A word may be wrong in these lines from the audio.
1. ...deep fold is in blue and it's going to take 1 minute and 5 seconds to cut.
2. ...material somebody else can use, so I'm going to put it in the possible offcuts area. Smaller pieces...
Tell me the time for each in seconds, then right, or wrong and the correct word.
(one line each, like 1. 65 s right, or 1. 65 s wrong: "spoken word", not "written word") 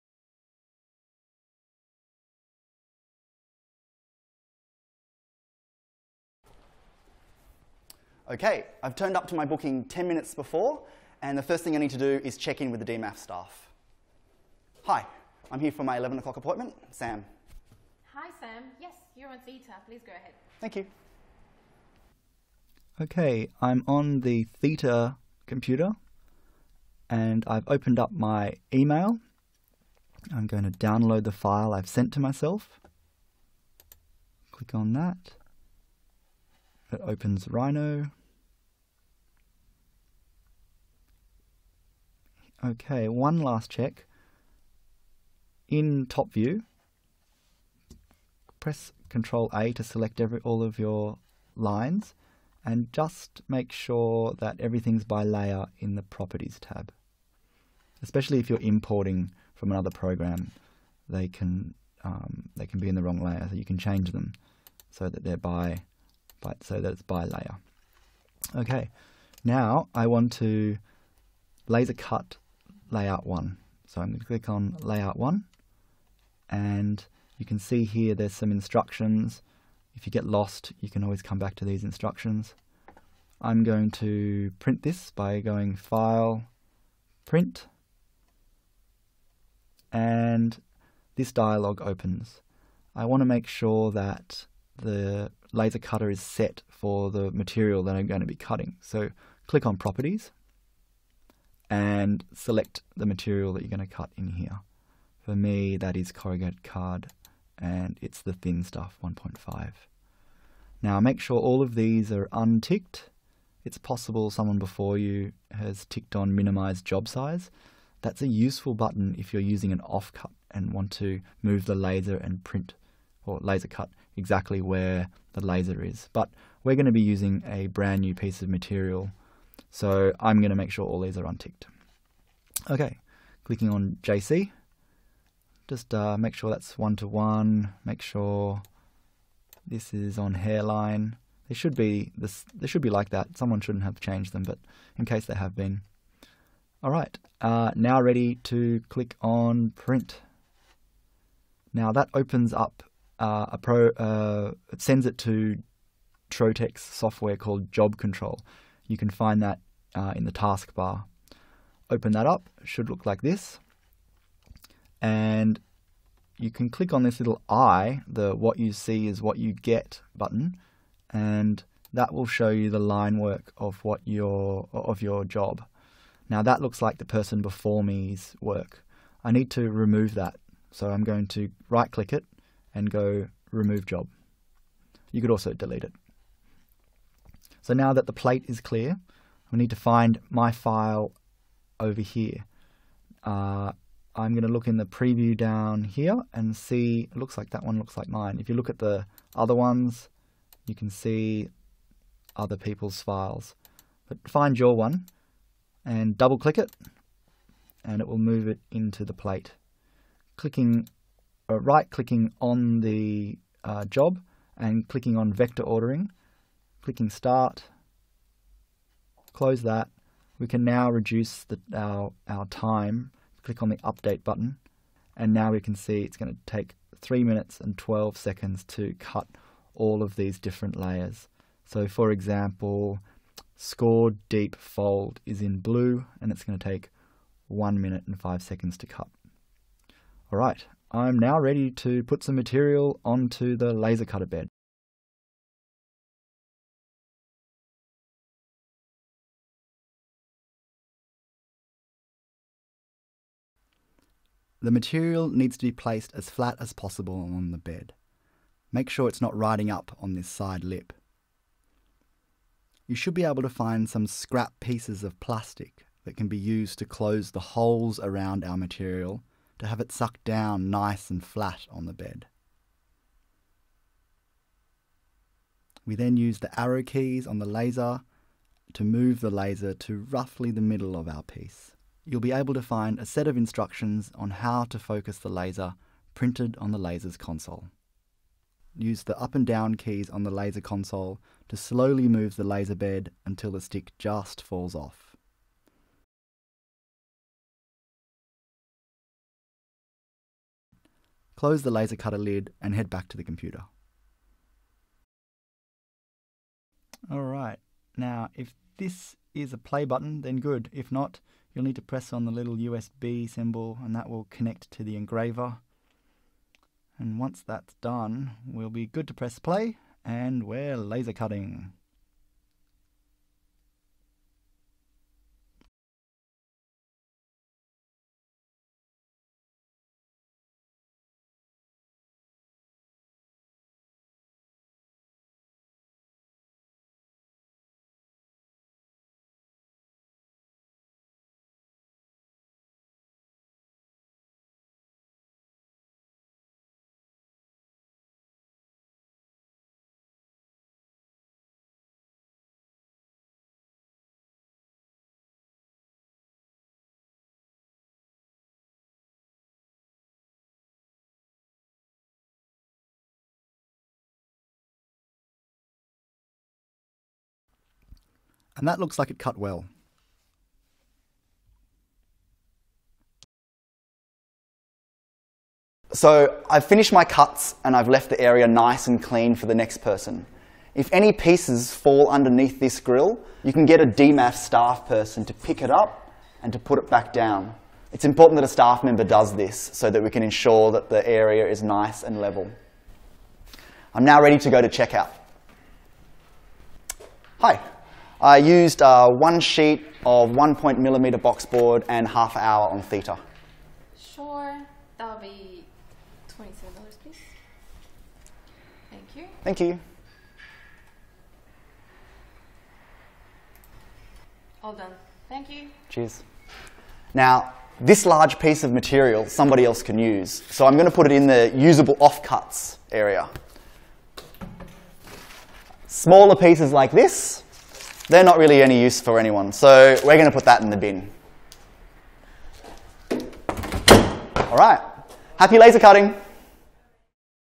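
1. 234 s right
2. 418 s wrong: "usable", not "possible".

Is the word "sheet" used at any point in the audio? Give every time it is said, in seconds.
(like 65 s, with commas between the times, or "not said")
399 s.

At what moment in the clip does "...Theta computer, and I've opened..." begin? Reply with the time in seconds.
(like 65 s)
24 s.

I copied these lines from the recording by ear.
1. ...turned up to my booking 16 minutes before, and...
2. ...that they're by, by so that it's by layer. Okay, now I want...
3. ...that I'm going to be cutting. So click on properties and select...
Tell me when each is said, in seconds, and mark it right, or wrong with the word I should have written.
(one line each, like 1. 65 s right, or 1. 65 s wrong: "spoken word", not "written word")
1. 8 s wrong: "10", not "16"
2. 65 s right
3. 97 s right.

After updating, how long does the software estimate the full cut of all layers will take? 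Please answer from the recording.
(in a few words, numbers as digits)
3 minutes 12 seconds.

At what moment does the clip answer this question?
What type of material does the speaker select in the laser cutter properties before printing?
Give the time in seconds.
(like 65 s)
106 s.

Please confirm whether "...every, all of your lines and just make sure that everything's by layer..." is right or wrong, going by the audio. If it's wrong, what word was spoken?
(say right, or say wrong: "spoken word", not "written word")
right.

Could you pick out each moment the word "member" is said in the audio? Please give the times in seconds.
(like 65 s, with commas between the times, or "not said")
388 s.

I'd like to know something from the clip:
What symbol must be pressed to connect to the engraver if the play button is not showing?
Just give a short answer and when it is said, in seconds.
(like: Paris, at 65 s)
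USB symbol, at 312 s.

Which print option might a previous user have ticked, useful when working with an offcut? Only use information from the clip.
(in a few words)
Minimize job size.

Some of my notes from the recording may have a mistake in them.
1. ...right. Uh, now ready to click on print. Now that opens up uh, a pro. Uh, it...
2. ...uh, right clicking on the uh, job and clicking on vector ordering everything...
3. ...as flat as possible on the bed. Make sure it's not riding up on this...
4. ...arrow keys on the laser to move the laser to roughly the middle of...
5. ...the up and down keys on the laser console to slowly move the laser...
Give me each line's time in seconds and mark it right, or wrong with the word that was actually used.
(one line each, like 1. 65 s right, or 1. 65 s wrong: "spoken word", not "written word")
1. 146 s right
2. 211 s wrong: "clicking", not "everything"
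3. 256 s right
4. 276 s right
5. 289 s right.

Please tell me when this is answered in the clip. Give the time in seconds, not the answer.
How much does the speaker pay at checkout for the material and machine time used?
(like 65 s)
406 s.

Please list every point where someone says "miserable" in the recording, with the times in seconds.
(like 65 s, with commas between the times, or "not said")
not said.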